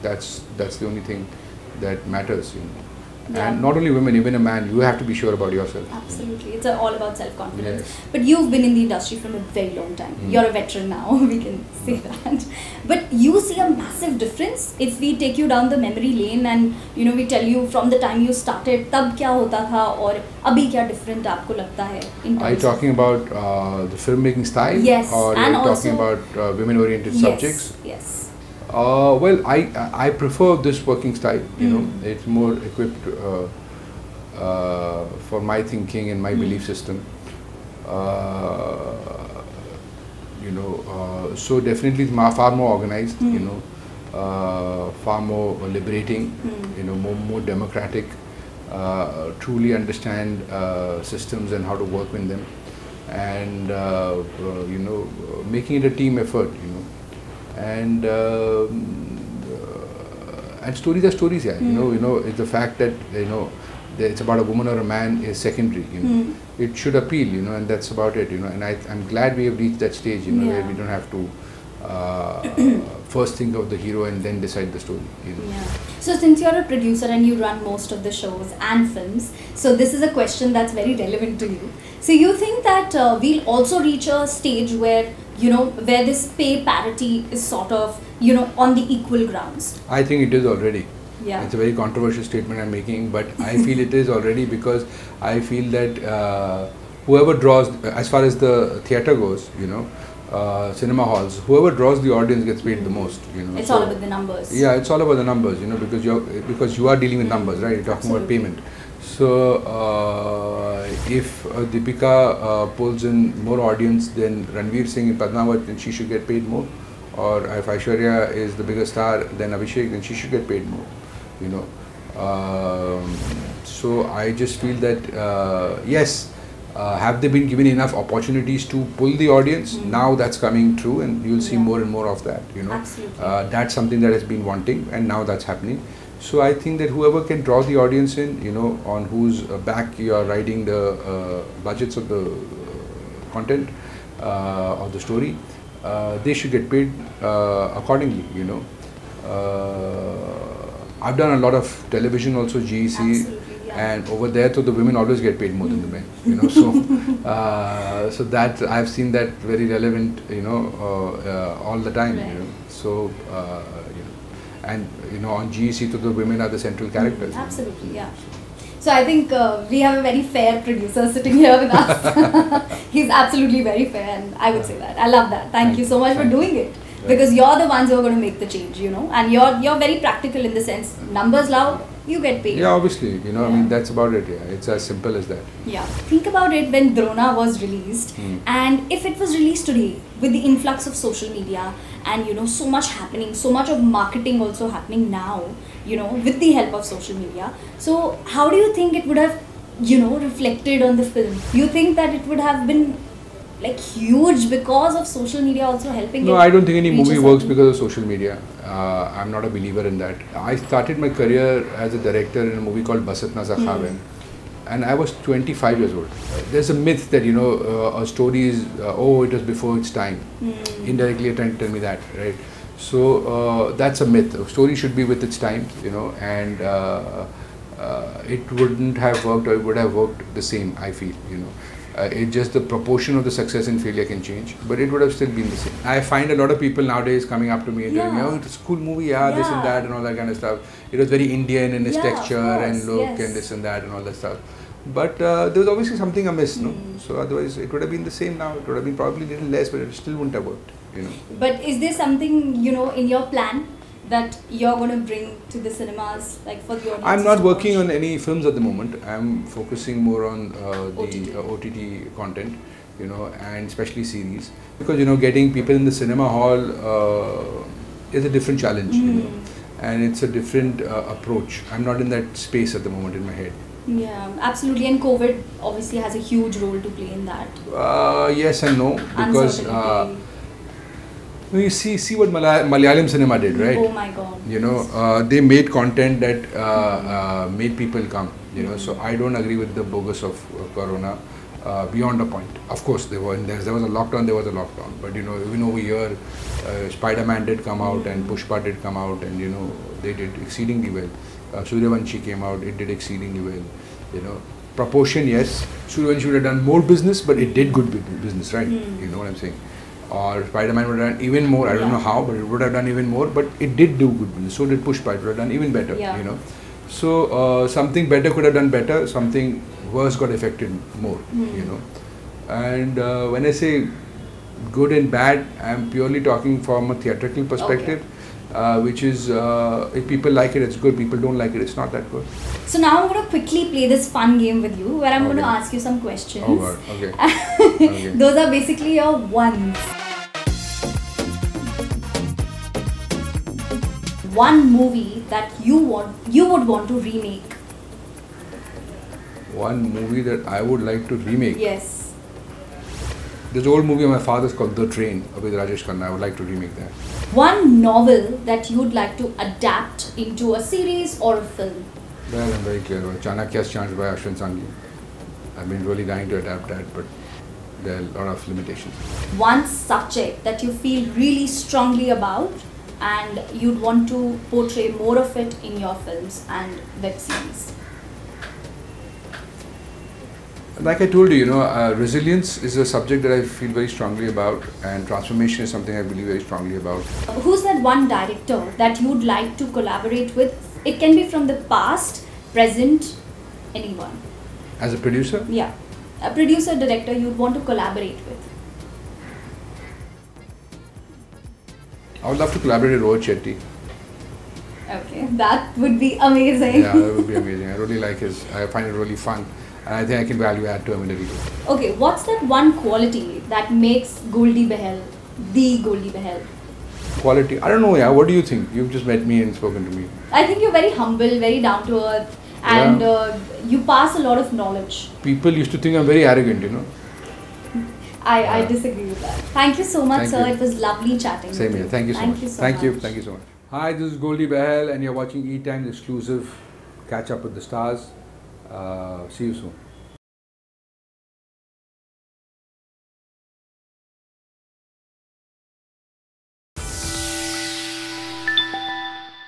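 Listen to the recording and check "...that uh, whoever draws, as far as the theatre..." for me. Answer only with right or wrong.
right.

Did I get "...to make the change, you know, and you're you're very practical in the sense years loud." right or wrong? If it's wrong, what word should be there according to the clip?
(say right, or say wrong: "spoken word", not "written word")
wrong: "numbers", not "years".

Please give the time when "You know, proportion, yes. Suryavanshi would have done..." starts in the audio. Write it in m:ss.
5:04.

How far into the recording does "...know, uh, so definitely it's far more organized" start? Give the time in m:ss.
0:40.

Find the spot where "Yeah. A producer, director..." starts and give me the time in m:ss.
6:35.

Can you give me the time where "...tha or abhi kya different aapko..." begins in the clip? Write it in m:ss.
0:19.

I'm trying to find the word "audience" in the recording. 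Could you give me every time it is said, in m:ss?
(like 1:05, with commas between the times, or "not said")
1:42, 1:53, 2:09, 2:17, 4:16.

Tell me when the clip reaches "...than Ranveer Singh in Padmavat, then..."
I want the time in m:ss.
1:54.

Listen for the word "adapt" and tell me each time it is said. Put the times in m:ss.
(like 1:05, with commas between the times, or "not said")
5:59, 6:06.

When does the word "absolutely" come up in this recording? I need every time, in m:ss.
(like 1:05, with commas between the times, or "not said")
0:05, 1:48, 2:47, 2:53, 4:34.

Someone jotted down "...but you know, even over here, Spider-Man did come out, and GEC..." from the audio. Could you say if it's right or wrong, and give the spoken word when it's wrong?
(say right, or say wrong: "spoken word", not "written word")
wrong: "Pushpa", not "GEC".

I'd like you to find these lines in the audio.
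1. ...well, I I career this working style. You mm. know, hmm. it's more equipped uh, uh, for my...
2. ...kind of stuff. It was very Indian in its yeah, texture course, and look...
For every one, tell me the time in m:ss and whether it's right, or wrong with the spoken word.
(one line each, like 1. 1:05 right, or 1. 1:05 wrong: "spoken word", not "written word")
1. 0:29 wrong: "prefer", not "career"
2. 4:00 right.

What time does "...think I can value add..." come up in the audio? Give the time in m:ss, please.
6:50.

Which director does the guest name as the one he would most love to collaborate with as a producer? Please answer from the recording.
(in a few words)
Rohit Shetty.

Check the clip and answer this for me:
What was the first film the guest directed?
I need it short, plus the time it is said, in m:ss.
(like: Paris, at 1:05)
Bas Itna Sa Khwaab Hai, at 3:33.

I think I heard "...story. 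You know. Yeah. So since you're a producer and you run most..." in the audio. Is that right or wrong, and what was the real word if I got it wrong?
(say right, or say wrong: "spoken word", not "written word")
right.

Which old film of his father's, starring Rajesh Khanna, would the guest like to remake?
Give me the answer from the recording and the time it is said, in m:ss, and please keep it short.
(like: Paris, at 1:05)
The Train, at 5:54.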